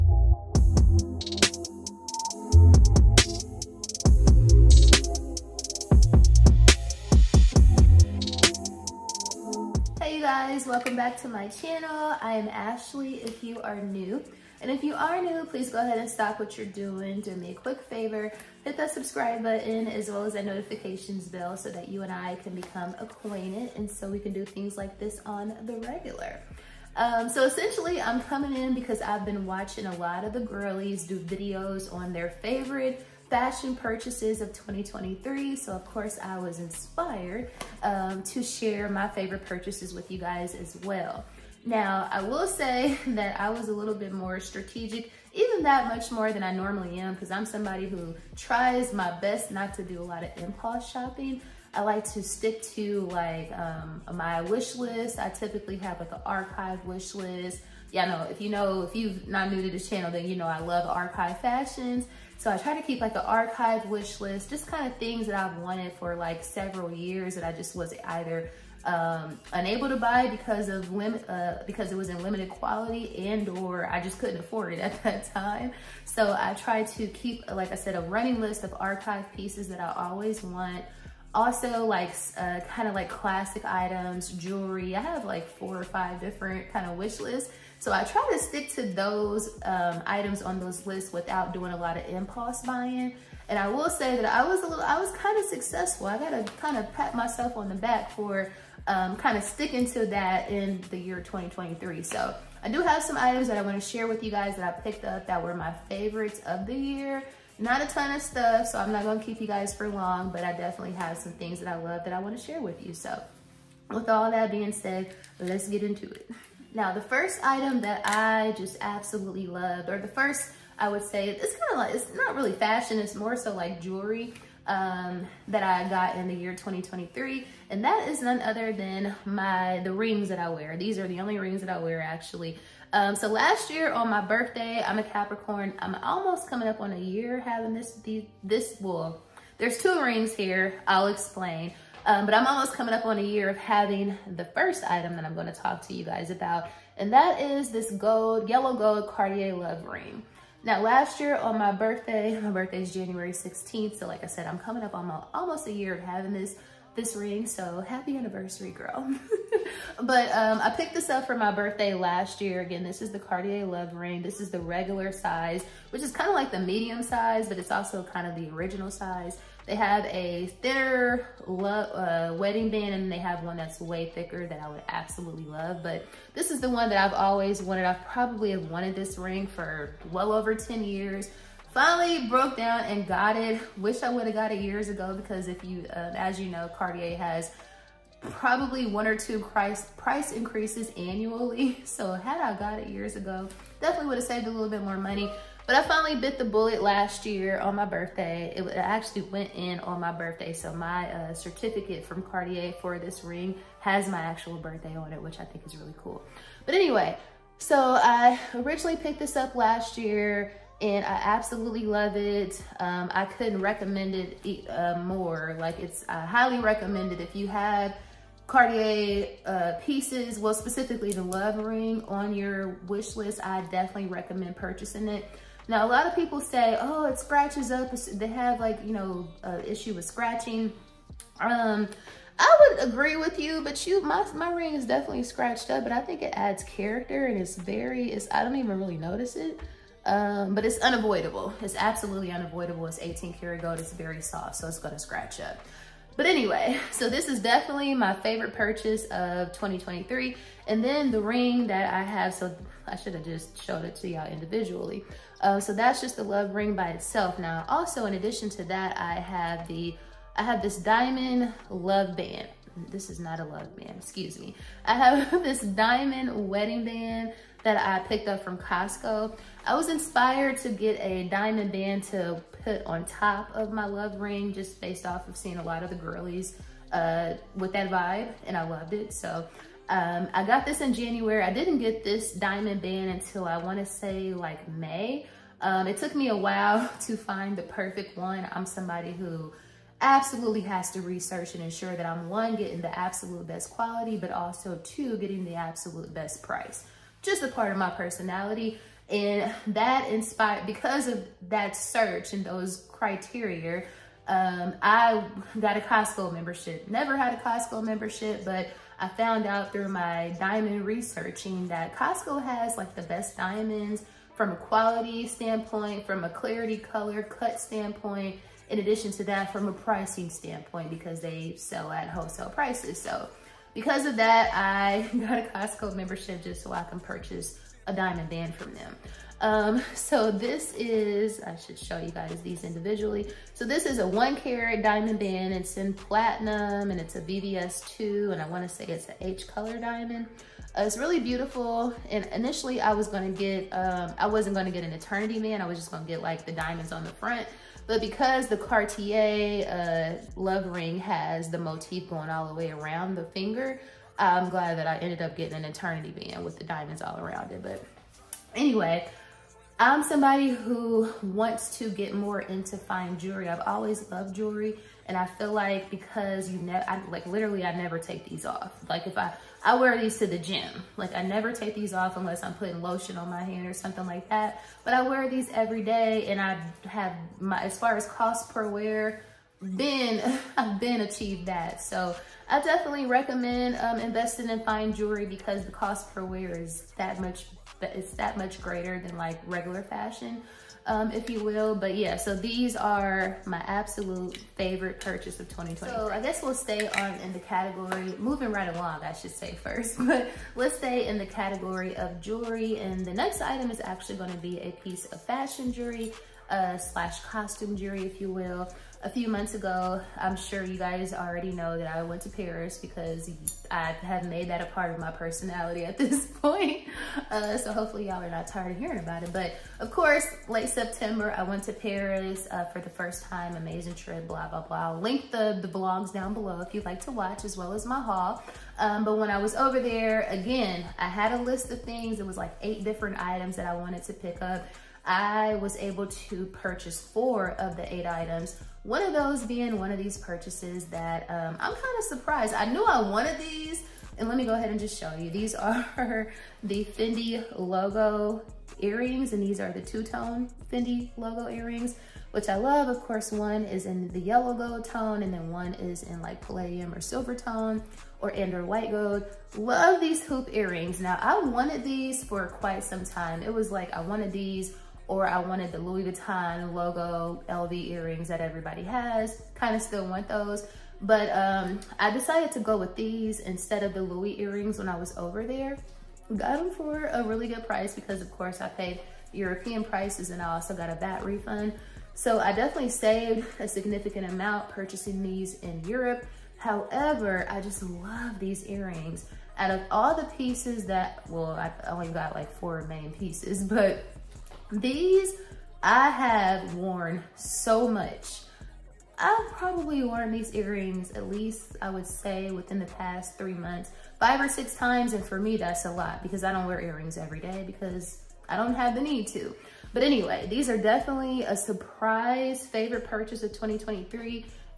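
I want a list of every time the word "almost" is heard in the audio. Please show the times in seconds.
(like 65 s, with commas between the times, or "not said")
136 s, 142 s, 155 s.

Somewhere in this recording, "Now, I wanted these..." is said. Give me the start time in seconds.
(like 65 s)
461 s.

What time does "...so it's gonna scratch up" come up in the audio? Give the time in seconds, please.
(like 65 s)
244 s.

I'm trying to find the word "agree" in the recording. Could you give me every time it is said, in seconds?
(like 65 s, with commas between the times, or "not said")
232 s.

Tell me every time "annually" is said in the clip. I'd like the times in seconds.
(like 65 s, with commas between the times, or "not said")
190 s.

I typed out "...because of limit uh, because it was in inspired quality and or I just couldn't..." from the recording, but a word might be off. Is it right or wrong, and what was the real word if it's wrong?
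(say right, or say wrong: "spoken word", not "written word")
wrong: "limited", not "inspired".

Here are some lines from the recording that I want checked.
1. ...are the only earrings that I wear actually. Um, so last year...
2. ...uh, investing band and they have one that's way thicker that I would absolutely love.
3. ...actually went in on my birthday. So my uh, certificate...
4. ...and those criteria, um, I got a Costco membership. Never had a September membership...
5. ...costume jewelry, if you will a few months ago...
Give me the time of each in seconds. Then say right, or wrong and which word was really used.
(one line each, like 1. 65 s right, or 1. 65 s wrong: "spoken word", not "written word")
1. 130 s wrong: "rings", not "earrings"
2. 171 s wrong: "wedding", not "investing"
3. 198 s right
4. 302 s wrong: "Costco", not "September"
5. 407 s right.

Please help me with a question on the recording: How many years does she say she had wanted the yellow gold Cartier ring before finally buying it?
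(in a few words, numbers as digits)
over 10 years.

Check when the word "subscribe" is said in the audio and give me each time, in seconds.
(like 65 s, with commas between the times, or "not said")
18 s.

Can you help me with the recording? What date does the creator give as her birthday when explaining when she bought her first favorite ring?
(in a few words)
January 16th.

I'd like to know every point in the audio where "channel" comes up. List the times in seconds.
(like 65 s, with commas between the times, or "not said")
11 s, 59 s.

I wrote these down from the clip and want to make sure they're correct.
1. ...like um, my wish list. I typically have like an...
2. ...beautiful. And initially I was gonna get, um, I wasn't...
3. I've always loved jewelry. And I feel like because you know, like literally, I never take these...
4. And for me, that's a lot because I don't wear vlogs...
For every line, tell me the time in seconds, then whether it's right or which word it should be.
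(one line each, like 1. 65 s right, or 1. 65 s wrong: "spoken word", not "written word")
1. 53 s right
2. 341 s right
3. 363 s right
4. 505 s wrong: "earrings", not "vlogs".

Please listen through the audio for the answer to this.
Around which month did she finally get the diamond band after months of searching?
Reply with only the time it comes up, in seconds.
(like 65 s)
284 s.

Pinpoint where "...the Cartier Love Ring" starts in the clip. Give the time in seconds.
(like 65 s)
163 s.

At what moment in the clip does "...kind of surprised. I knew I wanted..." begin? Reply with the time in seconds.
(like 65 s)
441 s.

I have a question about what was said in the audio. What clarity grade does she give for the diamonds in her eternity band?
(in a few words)
VVS2.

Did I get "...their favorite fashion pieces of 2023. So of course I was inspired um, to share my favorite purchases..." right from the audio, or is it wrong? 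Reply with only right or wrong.
wrong.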